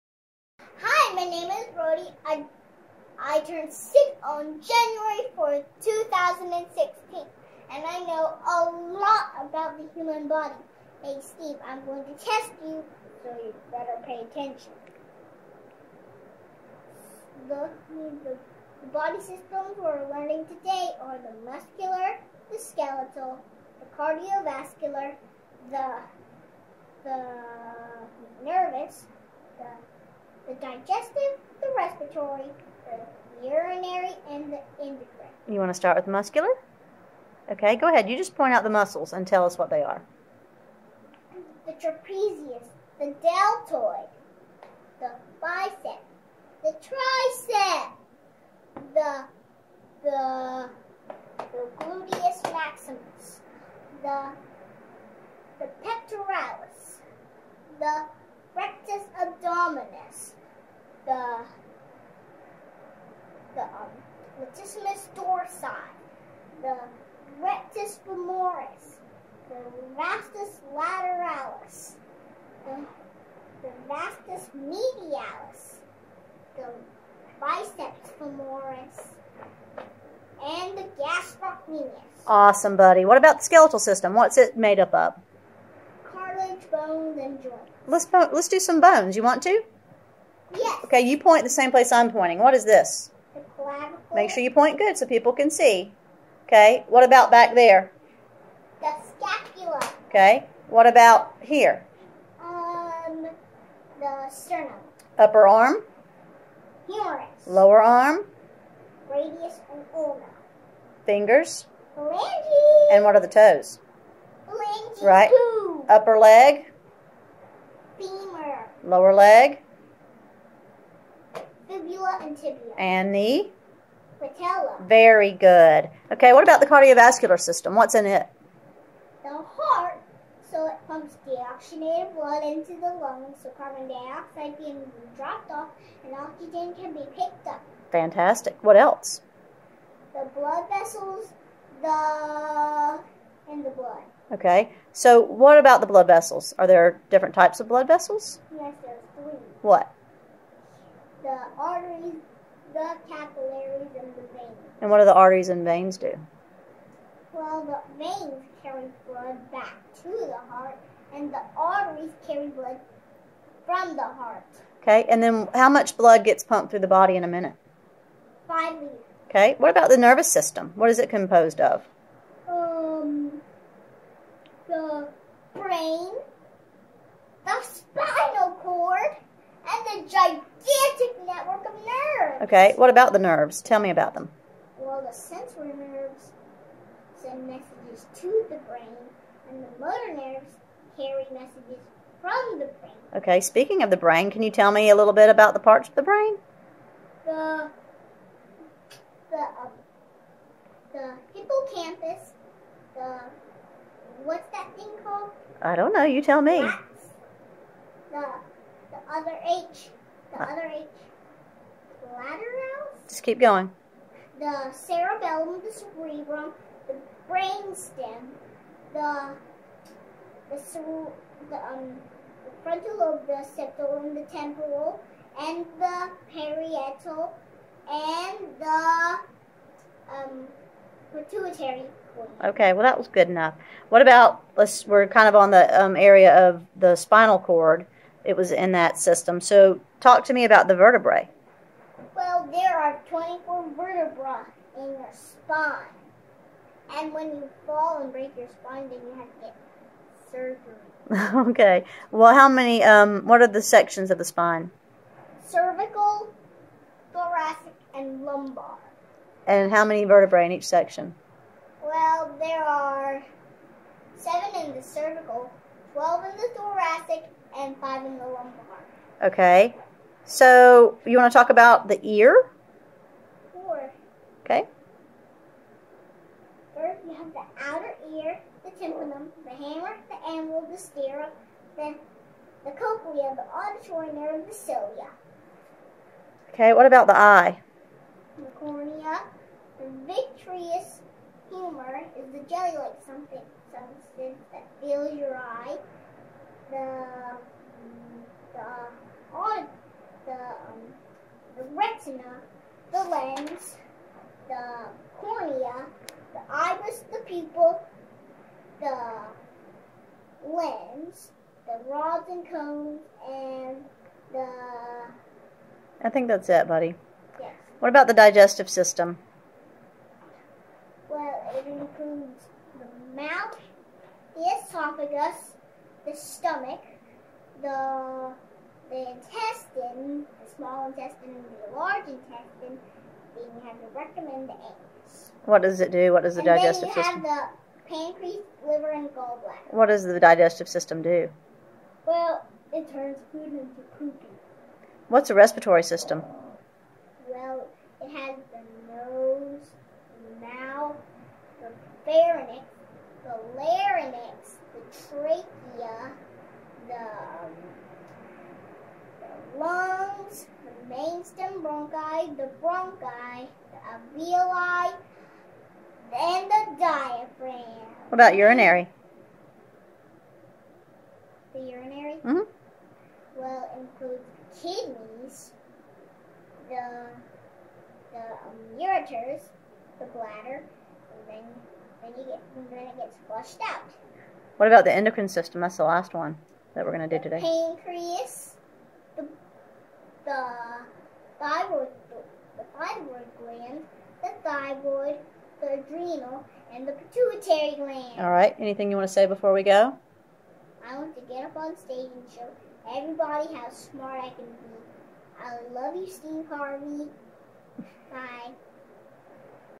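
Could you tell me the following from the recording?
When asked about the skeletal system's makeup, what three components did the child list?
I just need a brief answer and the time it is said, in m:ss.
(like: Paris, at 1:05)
Cartilage, bones, and joints, at 1:26.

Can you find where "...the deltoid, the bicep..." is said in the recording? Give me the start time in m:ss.
0:42.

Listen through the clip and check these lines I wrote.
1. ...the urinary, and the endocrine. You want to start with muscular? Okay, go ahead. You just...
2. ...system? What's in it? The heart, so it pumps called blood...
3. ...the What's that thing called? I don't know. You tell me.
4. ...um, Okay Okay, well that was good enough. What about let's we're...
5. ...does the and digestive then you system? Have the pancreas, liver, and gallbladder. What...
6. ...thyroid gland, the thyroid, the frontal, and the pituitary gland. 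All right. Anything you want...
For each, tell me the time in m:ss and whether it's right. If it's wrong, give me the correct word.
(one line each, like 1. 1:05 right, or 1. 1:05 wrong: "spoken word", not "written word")
1. 0:32 right
2. 2:07 wrong: "deoxygenated", not "called"
3. 3:22 right
4. 3:50 wrong: "Pituitary", not "Okay"
5. 5:36 right
6. 6:32 wrong: "adrenal", not "frontal".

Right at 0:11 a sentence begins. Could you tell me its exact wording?
Hey, Steve, I'm going to test you, so you better pay attention.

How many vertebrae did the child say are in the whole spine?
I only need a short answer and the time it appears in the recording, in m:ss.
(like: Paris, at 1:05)
24, at 4:03.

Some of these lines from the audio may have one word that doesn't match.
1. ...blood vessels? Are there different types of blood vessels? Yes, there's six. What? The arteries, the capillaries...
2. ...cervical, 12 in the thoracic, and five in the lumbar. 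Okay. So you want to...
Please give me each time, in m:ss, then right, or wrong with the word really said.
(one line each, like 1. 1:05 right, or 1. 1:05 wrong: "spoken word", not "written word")
1. 2:25 wrong: "three", not "six"
2. 4:24 right.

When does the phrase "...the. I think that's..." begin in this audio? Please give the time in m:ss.
5:14.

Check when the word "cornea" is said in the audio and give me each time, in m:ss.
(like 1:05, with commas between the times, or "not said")
4:48, 5:05.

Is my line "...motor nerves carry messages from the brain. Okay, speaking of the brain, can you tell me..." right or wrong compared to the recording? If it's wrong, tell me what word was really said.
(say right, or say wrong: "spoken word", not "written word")
right.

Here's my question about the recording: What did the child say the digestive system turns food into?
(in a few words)
Poopy.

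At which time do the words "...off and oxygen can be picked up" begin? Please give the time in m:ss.
2:15.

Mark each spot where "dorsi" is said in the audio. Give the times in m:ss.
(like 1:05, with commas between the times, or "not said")
1:05.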